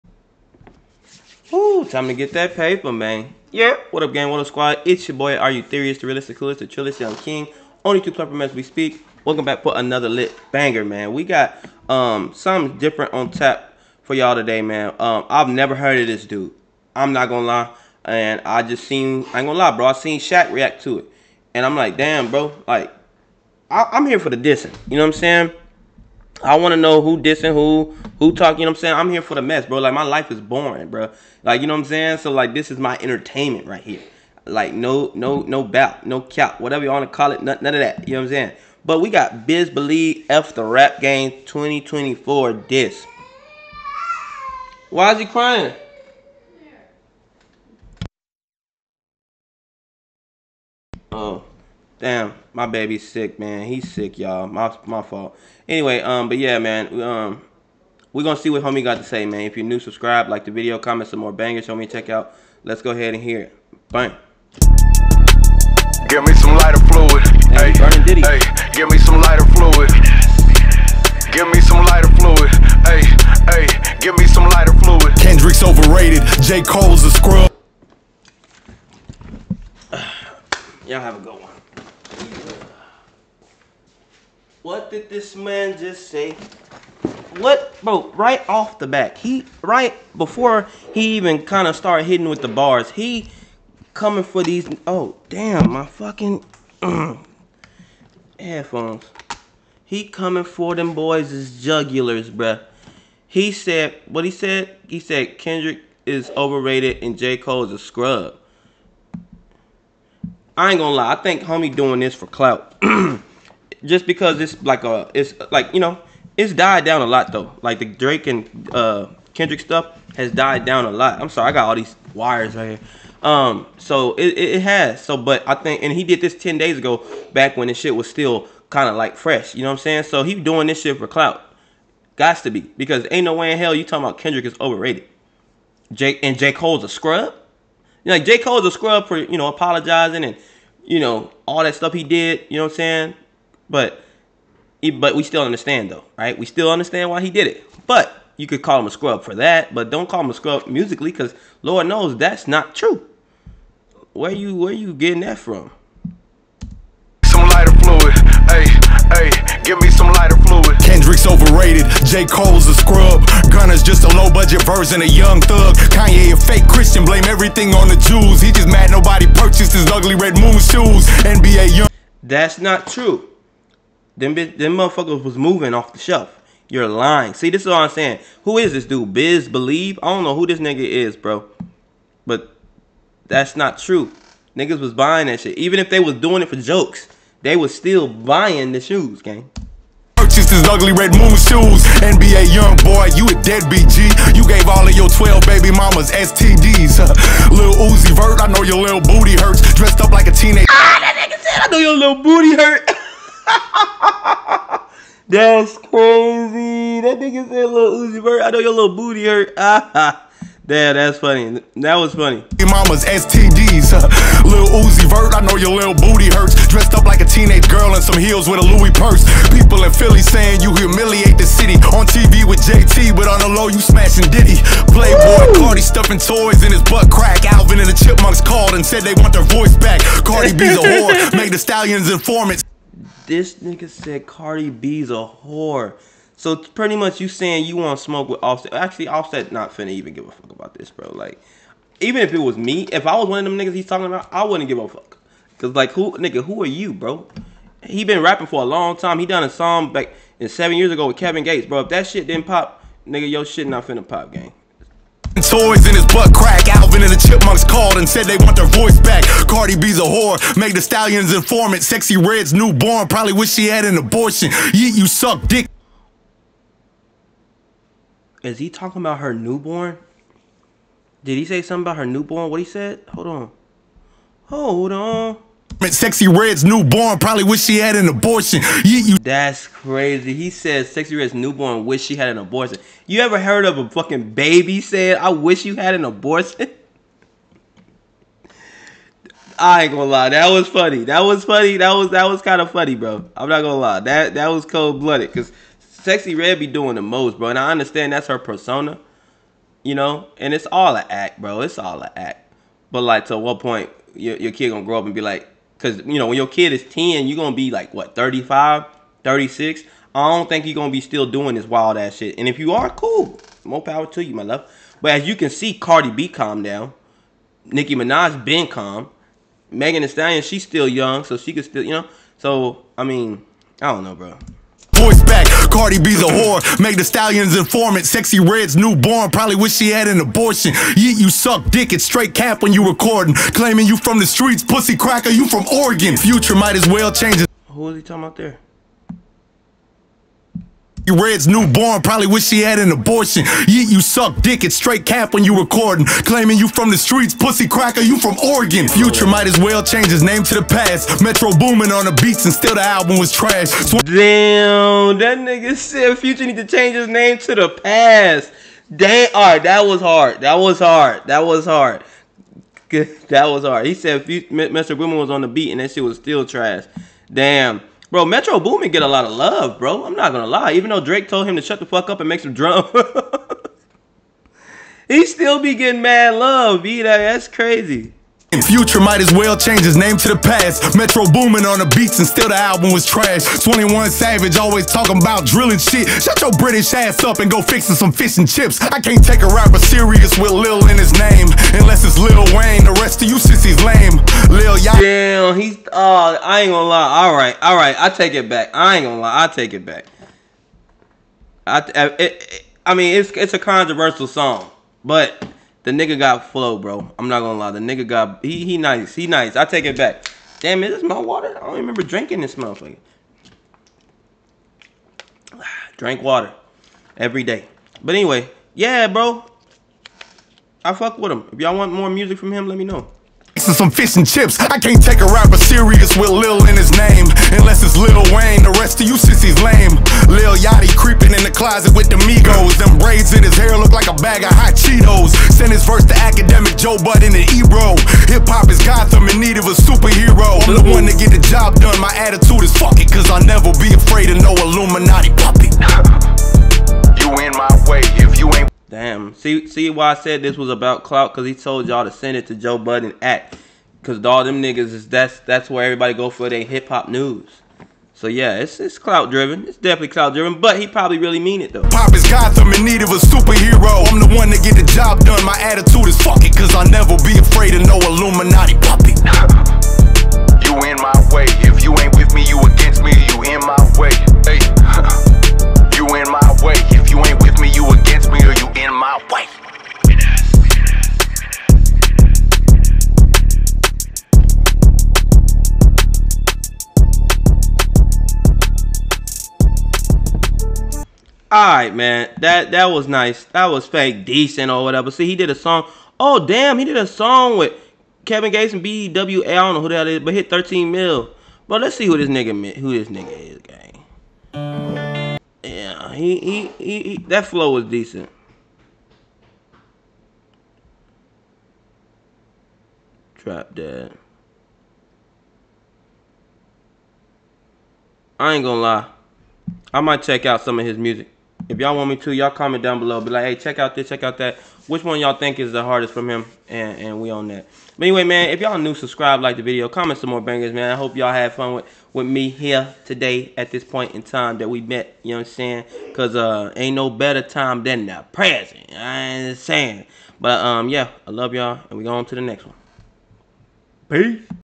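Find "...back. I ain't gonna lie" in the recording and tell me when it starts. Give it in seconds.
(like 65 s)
398 s.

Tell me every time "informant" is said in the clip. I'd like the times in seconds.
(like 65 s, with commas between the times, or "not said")
232 s, 261 s, 327 s.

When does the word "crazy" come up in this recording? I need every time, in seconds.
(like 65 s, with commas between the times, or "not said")
205 s, 279 s, 377 s.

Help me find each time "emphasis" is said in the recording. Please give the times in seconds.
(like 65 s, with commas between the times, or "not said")
not said.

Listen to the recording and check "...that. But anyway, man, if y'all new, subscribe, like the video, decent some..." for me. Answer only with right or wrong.
wrong.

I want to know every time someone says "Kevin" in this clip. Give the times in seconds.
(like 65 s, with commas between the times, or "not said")
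251 s, 498 s.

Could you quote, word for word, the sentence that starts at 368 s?
Bro, Metro Boomin get a lot of love, bro.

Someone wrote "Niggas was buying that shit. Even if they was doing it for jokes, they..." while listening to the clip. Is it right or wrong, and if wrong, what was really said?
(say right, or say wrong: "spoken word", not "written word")
right.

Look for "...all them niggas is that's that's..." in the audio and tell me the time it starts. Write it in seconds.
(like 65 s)
454 s.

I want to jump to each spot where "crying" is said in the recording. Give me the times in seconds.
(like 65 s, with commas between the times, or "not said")
45 s.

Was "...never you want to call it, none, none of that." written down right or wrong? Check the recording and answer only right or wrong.
wrong.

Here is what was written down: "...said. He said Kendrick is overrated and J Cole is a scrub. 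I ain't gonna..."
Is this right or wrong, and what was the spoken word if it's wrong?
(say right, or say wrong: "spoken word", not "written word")
right.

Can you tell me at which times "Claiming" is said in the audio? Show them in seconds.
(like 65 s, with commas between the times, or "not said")
333 s, 346 s.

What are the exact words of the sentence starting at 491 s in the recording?
all right, man, that that was nice.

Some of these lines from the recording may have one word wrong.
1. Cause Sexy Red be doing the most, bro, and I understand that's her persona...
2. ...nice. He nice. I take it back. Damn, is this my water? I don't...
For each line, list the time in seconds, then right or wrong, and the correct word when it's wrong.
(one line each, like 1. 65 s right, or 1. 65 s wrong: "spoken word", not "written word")
1. 295 s right
2. 408 s right.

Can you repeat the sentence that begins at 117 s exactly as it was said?
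Like the Drake and uh, Kendrick stuff has died down a lot.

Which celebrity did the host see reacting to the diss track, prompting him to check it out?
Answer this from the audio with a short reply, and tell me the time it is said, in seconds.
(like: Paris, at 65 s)
Shaq, at 20 s.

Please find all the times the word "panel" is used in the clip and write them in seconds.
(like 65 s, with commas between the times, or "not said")
not said.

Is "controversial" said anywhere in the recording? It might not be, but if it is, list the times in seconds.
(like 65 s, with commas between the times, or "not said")
403 s.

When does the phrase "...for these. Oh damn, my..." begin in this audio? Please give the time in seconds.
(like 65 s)
94 s.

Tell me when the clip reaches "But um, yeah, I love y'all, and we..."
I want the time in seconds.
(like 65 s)
540 s.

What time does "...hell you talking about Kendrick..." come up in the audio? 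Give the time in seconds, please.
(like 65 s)
133 s.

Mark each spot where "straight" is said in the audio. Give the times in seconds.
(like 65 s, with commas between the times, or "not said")
332 s, 344 s.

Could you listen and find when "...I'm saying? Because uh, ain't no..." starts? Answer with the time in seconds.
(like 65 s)
535 s.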